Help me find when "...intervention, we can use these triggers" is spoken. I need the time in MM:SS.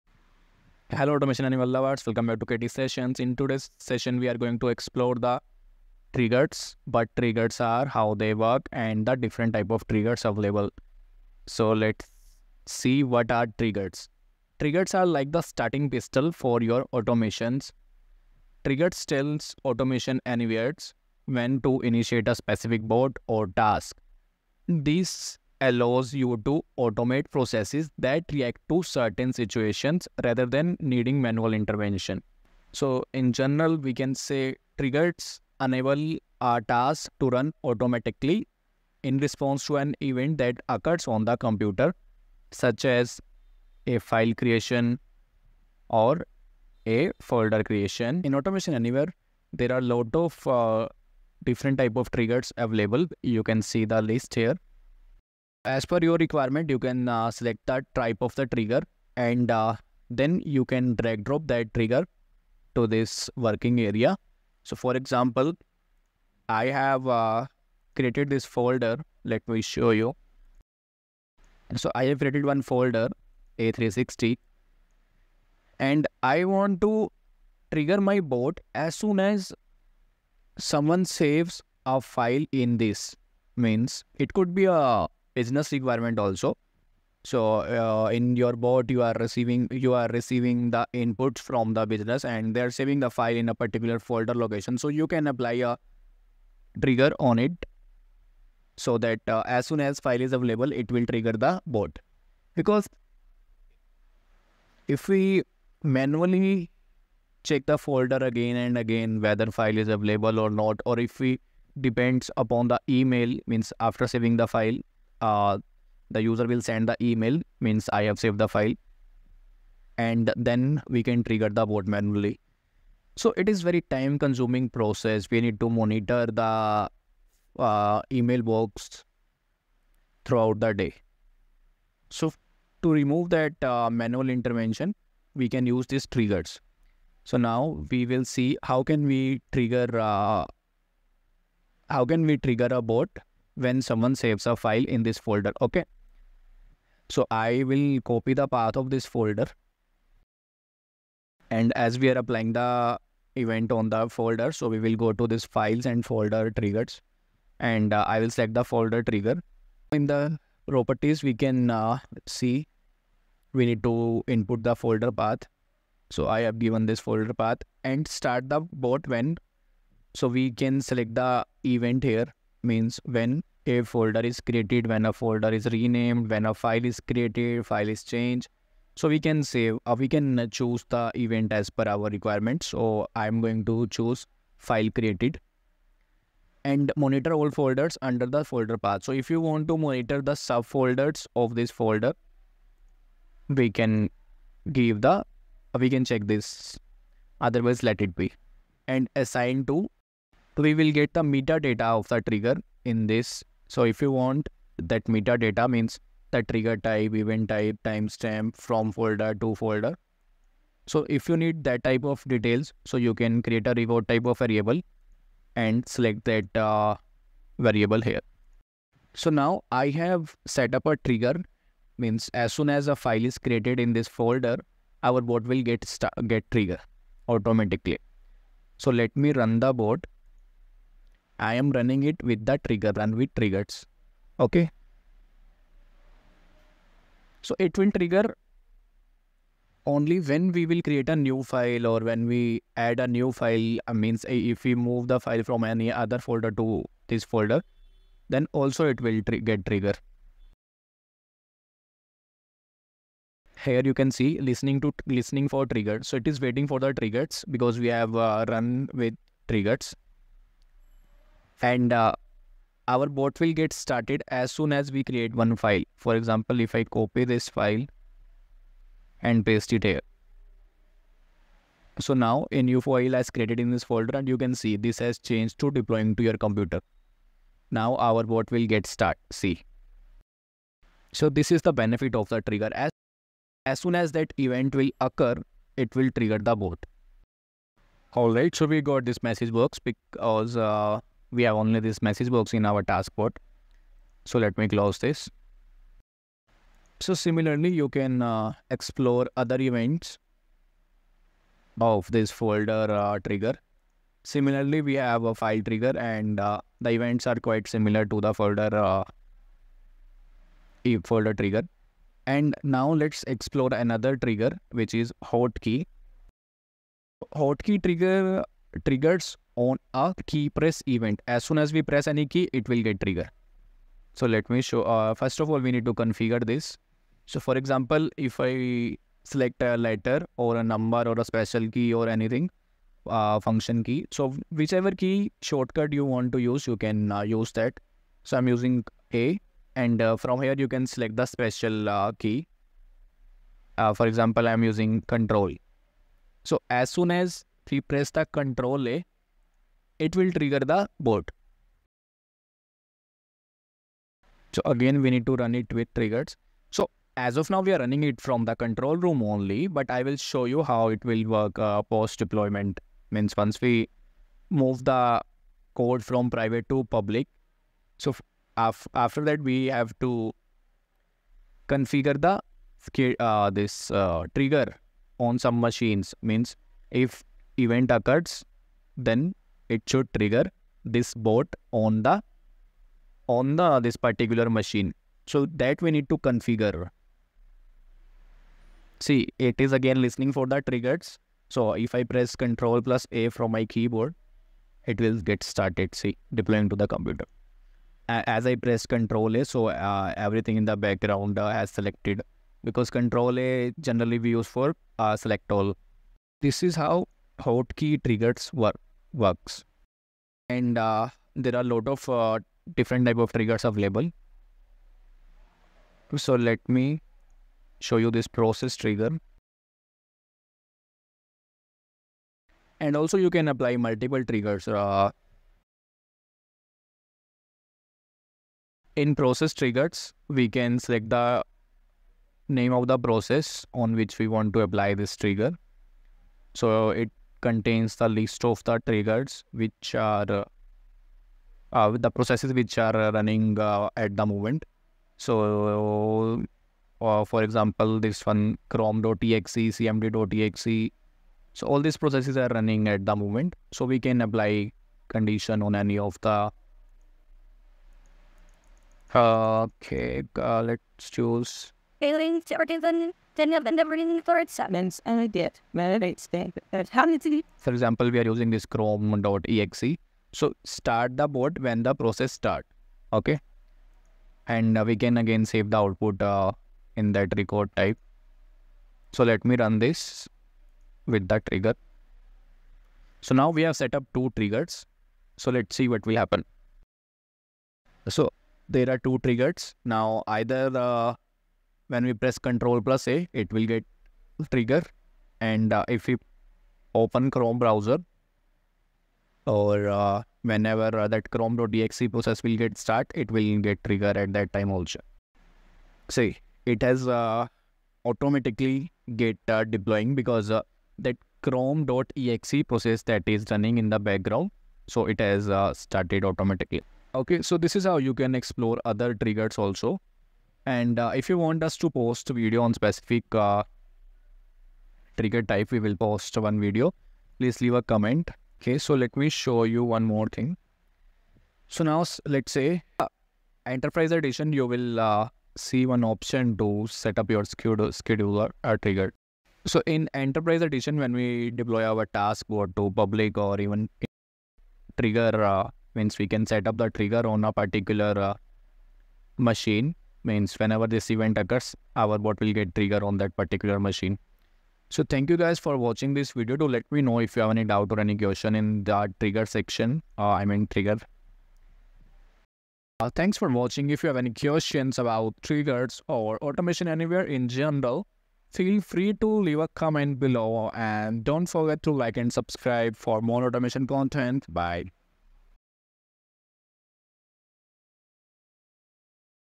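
02:14.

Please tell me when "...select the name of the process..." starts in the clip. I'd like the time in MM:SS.
07:10.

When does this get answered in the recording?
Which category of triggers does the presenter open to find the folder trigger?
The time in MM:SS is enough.
02:35.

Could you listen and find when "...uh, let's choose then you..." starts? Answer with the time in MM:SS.
07:40.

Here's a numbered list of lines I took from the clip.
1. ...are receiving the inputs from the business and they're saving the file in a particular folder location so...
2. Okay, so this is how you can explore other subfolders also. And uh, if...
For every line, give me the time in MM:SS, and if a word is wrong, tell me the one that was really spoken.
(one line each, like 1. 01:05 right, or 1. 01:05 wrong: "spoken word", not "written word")
1. 01:29 right
2. 08:37 wrong: "triggers", not "subfolders".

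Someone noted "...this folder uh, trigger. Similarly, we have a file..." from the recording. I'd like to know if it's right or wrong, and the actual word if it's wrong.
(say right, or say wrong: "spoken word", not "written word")
right.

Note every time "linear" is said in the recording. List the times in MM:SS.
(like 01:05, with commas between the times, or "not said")
not said.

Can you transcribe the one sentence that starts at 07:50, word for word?
So start the bot when the process start.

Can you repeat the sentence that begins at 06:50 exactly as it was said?
And uh, there are a lot of uh, different type of triggers available.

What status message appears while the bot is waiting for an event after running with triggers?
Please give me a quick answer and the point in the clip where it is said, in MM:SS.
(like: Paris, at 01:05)
listening for trigger, at 04:15.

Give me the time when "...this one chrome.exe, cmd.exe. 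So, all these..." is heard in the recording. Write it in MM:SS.
07:27.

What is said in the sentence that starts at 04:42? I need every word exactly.
As, as soon as that event will occur, it will trigger the bot.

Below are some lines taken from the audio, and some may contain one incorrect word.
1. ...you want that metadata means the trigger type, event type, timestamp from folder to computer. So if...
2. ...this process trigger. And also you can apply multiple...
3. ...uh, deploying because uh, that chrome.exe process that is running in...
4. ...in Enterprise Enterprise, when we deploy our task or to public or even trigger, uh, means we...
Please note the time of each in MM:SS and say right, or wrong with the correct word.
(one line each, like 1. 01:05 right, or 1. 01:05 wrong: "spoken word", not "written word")
1. 03:24 wrong: "folder", not "computer"
2. 06:58 right
3. 08:29 right
4. 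08:59 wrong: "Edition", not "Enterprise".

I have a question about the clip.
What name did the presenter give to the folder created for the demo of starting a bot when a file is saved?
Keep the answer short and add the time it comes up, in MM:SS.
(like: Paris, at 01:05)
a360, at 01:13.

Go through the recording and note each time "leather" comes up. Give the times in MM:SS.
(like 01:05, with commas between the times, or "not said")
not said.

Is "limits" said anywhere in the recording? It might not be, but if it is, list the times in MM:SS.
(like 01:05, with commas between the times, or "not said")
not said.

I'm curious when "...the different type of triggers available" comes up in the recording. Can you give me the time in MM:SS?
00:09.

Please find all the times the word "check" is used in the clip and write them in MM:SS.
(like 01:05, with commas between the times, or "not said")
01:47, 03:16.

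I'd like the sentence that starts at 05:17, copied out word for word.
Hotkey trigger triggers on a key press event.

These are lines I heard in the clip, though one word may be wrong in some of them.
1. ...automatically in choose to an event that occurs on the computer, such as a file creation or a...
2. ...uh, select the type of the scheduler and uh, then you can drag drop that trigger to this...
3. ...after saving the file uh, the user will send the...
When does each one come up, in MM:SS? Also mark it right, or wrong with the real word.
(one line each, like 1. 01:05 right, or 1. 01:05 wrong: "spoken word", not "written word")
1. 00:37 wrong: "response", not "choose"
2. 00:57 wrong: "trigger", not "scheduler"
3. 01:53 right.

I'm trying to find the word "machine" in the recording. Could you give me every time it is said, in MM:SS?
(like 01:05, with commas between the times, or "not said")
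06:15, 06:24, 09:09, 09:13.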